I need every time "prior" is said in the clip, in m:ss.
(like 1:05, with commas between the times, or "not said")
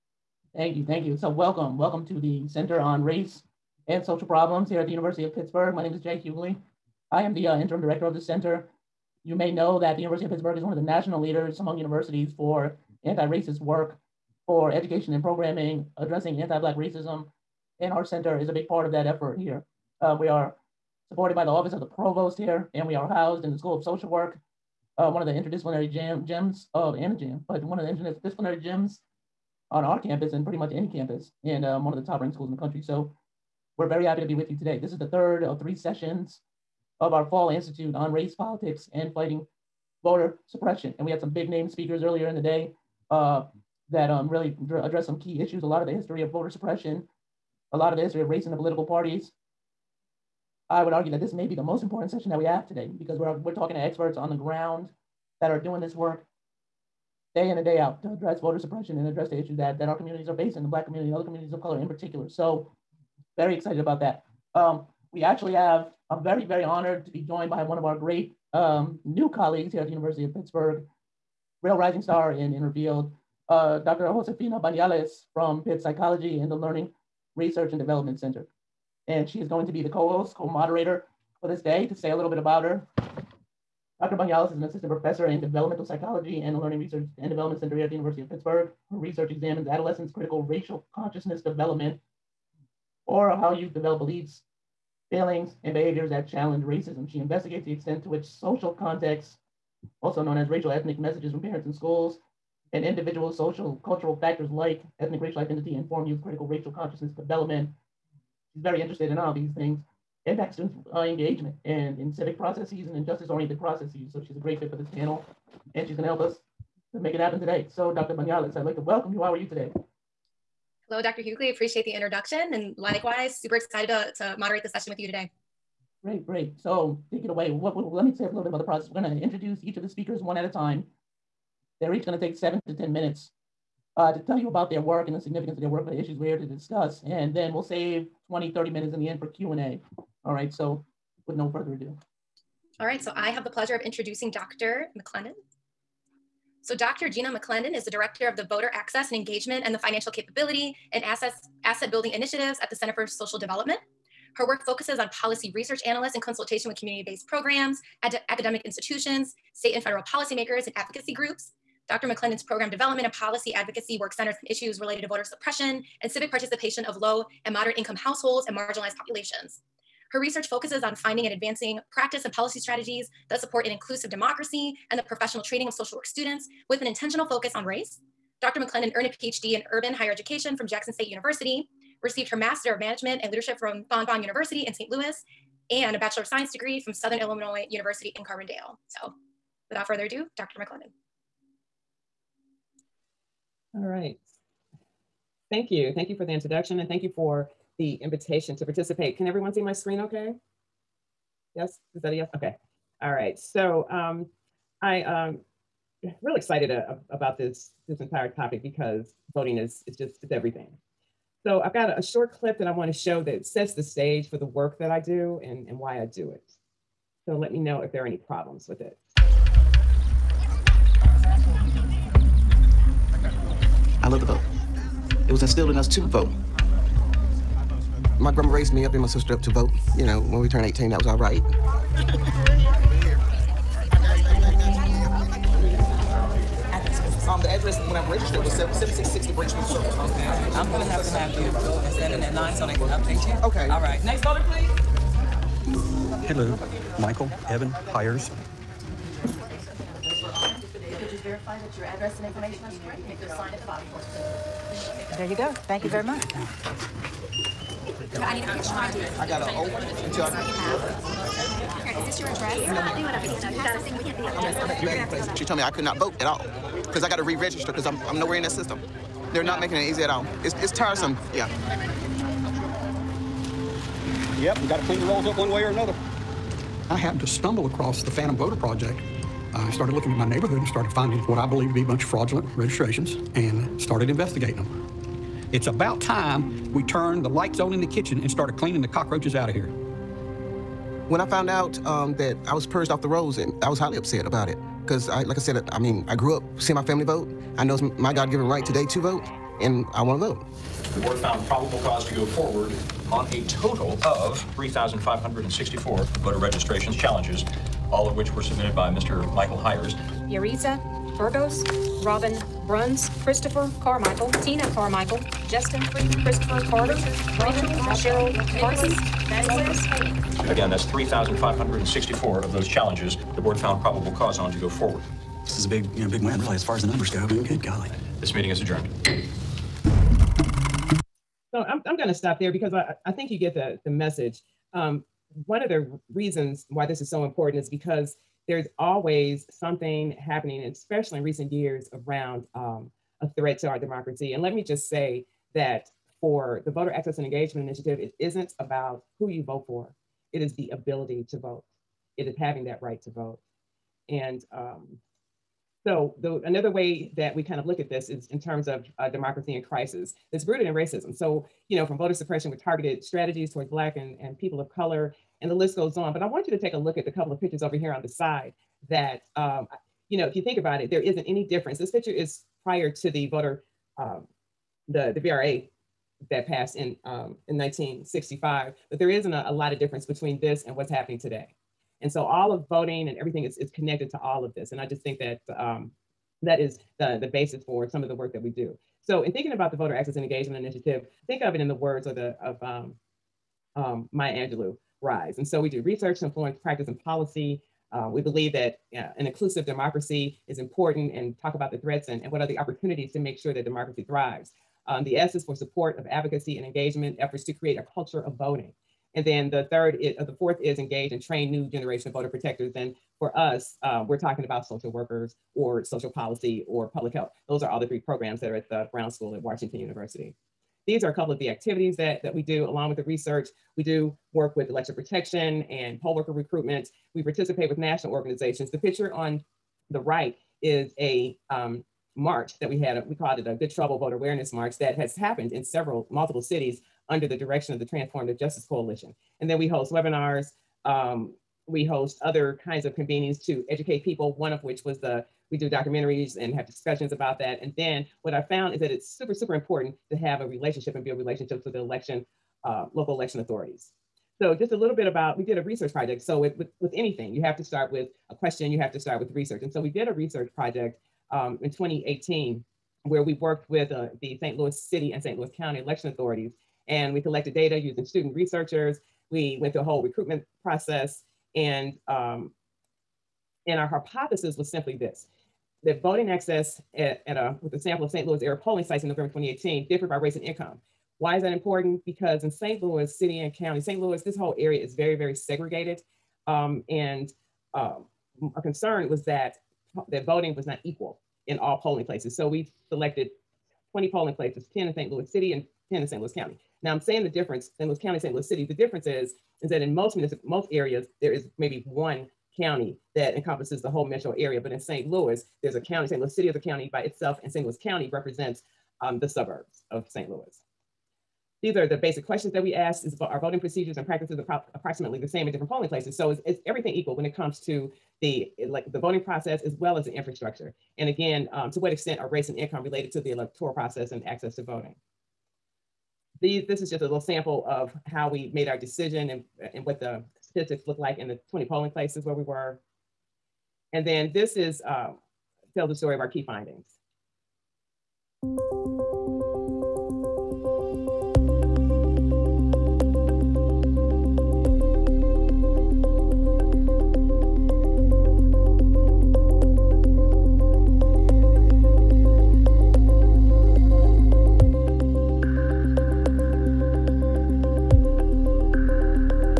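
6:12.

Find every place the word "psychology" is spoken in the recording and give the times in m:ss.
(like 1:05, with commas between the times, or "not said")
1:15, 1:25.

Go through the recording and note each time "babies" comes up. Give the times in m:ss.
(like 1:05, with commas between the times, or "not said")
not said.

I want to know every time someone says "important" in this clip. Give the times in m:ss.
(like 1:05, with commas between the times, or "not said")
0:51, 5:37, 6:40, 7:29, 8:01.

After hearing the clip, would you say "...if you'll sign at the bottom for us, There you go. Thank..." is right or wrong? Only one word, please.
right.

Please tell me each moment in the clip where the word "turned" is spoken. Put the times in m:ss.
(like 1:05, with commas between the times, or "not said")
3:50, 4:46.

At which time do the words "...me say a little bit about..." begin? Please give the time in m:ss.
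2:08.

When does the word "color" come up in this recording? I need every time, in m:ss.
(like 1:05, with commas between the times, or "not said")
1:01, 6:04.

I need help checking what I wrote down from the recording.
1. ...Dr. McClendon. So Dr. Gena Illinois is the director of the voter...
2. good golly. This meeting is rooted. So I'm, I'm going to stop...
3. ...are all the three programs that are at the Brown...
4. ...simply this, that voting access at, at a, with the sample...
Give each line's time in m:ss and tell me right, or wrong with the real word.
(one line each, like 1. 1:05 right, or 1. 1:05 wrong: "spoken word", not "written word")
1. 2:24 wrong: "McClendon", not "Illinois"
2. 5:27 wrong: "adjourned", not "rooted"
3. 6:57 right
4. 7:54 right.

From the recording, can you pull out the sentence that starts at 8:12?
So we selected 20 polling places, 10 in St.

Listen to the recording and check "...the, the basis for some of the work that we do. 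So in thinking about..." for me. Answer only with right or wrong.
right.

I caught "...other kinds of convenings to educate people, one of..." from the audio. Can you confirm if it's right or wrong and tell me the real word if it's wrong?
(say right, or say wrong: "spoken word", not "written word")
right.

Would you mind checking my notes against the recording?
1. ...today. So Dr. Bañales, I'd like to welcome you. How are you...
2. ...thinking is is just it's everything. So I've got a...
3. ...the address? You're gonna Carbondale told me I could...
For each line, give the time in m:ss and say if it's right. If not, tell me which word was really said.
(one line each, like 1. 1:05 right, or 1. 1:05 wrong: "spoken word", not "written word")
1. 1:57 right
2. 3:29 wrong: "voting", not "thinking"
3. 4:24 wrong: "She", not "Carbondale".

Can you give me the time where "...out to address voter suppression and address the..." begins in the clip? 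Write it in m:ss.
0:57.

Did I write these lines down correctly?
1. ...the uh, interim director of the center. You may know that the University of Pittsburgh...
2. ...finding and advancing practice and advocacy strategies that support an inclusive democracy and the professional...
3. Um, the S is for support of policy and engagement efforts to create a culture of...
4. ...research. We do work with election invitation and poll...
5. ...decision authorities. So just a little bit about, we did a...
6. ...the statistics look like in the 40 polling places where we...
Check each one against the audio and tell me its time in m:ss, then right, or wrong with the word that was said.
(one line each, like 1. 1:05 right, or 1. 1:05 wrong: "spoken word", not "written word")
1. 0:07 right
2. 2:50 wrong: "policy", not "advocacy"
3. 6:44 wrong: "advocacy", not "policy"
4. 7:03 wrong: "protection", not "invitation"
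5. 7:33 wrong: "election", not "decision"
6. 8:49 wrong: "20", not "40".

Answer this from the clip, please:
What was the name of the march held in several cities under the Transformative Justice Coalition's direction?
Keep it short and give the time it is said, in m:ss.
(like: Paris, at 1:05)
Good Trouble Voter Awareness March, at 7:13.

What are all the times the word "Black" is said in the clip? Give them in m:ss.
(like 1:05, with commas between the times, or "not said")
0:16, 1:00, 6:03.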